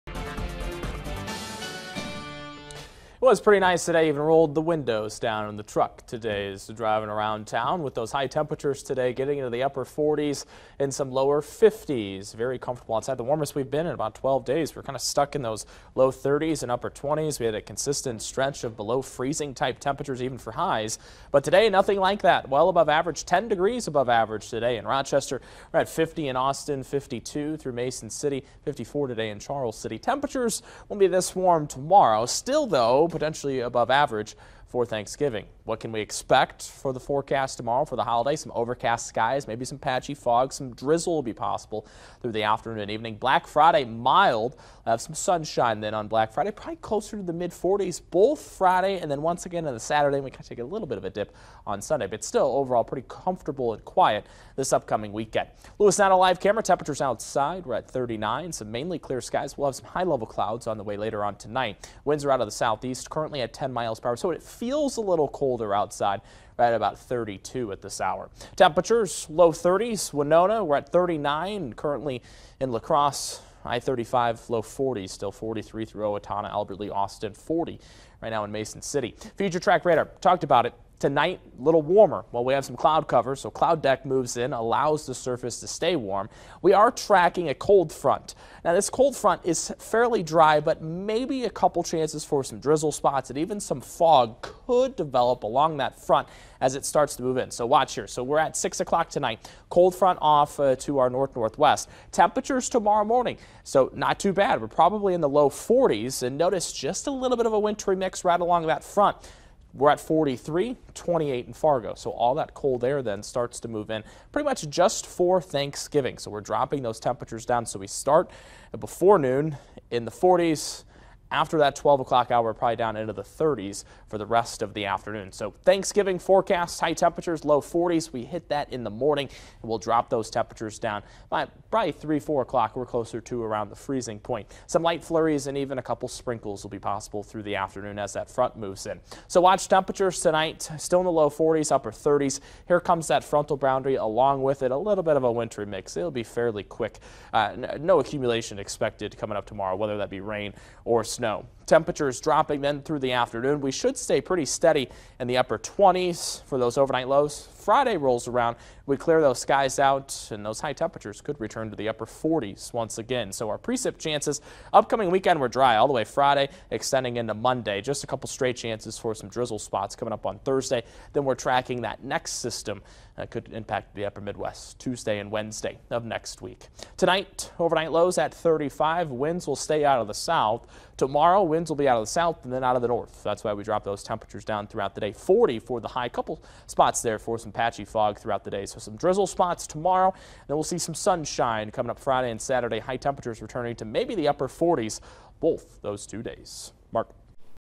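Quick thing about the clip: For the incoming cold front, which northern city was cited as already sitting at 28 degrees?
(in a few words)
Fargo.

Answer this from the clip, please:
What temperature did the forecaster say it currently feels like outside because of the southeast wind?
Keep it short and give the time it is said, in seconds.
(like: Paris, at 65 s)
32, at 66 s.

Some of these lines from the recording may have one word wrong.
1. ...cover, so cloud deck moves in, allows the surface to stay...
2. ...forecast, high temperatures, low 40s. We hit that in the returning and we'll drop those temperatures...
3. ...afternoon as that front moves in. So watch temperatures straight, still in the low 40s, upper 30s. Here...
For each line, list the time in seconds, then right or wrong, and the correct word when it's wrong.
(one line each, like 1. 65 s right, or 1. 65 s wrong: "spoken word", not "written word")
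1. 83 s right
2. 126 s wrong: "morning", not "returning"
3. 137 s wrong: "tonight", not "straight".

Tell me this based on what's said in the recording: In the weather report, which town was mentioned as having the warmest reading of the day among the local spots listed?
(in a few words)
Charles City.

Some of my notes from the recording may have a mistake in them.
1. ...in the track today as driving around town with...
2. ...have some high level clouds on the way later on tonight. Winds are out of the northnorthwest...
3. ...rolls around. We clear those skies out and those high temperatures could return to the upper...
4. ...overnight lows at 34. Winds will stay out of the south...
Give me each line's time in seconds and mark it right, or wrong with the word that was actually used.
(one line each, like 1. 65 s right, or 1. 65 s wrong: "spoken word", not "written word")
1. 5 s wrong: "truck", not "track"
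2. 59 s wrong: "southeast", not "northnorthwest"
3. 157 s right
4. 177 s wrong: "35", not "34".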